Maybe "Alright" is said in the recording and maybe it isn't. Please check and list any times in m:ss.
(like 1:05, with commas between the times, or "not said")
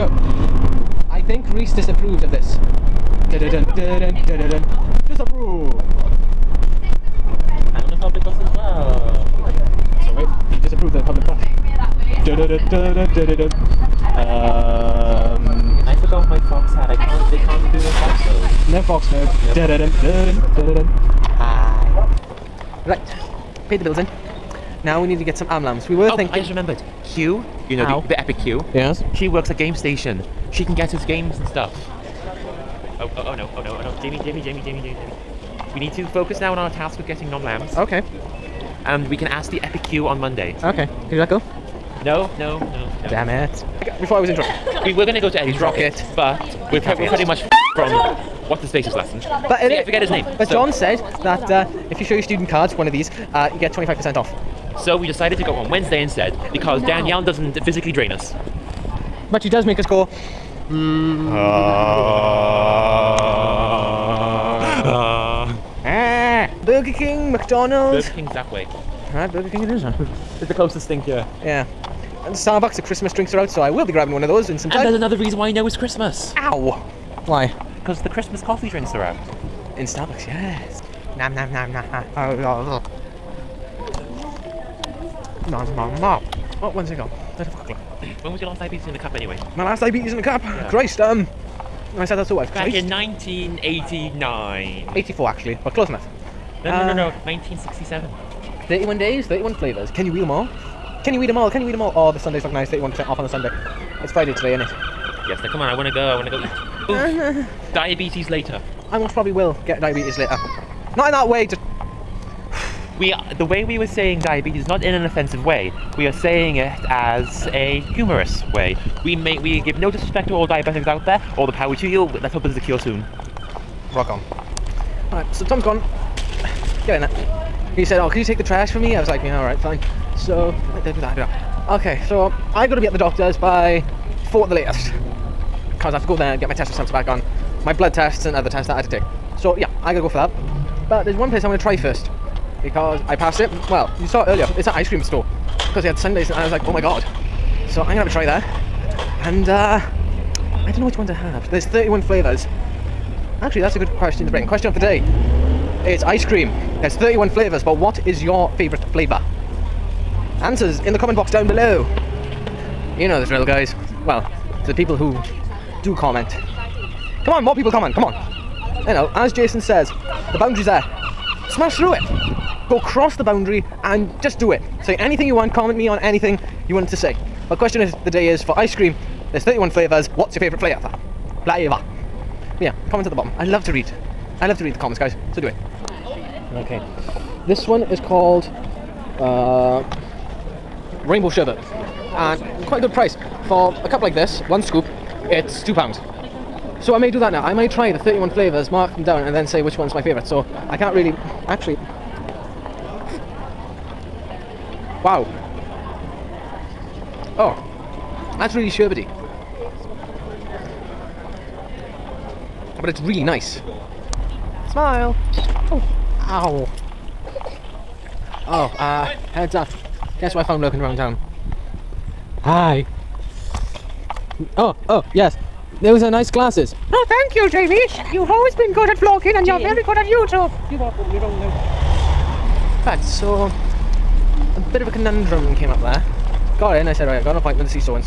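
1:09, 2:05.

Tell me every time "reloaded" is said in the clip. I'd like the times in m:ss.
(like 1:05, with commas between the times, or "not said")
not said.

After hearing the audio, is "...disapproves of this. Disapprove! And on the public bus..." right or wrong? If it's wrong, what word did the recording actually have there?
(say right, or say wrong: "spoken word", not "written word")
right.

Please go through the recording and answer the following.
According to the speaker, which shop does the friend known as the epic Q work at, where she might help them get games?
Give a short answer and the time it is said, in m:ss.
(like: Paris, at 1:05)
Game Station, at 0:29.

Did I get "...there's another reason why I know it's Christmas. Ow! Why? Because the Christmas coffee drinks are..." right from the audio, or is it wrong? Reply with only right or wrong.
right.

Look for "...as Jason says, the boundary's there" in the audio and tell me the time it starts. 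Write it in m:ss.
2:49.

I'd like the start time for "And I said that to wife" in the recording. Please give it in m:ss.
1:31.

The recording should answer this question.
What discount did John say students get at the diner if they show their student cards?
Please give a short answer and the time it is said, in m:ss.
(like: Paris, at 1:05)
25%, at 0:53.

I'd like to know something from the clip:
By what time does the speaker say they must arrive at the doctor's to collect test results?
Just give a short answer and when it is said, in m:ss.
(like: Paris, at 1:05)
4, at 2:14.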